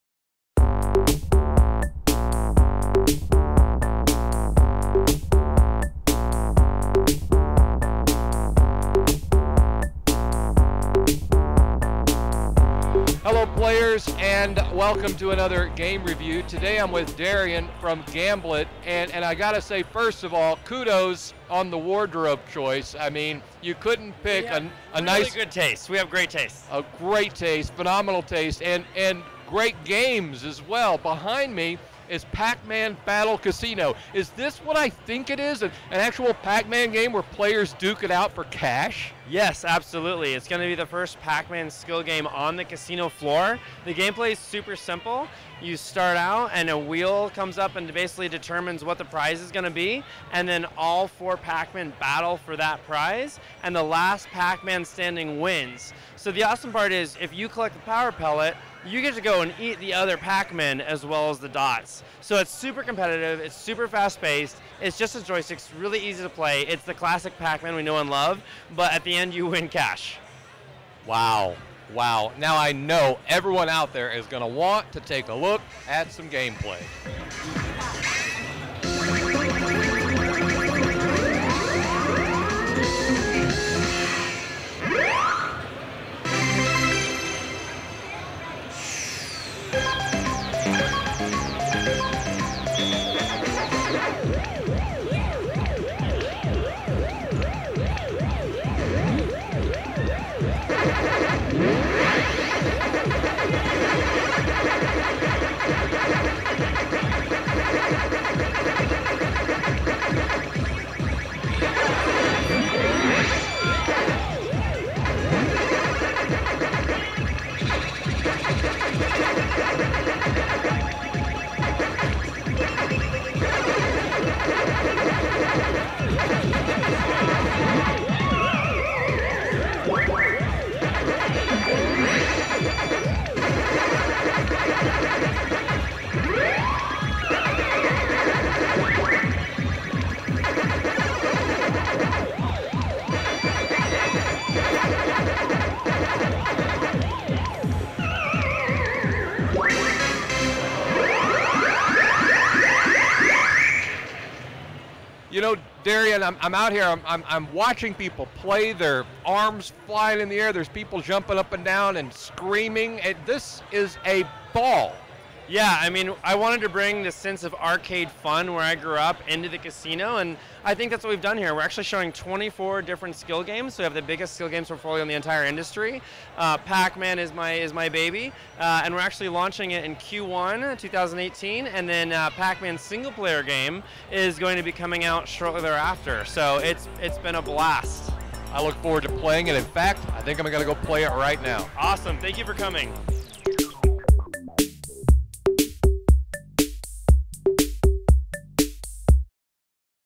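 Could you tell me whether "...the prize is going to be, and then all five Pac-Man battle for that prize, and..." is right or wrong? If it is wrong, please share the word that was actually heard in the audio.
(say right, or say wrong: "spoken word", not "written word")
wrong: "four", not "five".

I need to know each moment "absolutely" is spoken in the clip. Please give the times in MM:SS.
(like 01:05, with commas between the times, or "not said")
00:39.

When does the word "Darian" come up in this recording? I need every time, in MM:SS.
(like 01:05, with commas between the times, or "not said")
00:17, 02:35.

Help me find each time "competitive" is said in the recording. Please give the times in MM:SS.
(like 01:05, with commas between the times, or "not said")
01:02.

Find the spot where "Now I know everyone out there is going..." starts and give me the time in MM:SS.
01:12.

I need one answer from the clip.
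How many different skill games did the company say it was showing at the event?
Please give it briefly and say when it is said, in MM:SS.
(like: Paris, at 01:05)
24, at 02:52.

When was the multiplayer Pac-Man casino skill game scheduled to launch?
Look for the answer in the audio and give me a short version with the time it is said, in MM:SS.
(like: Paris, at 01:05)
Q1 2018, at 02:59.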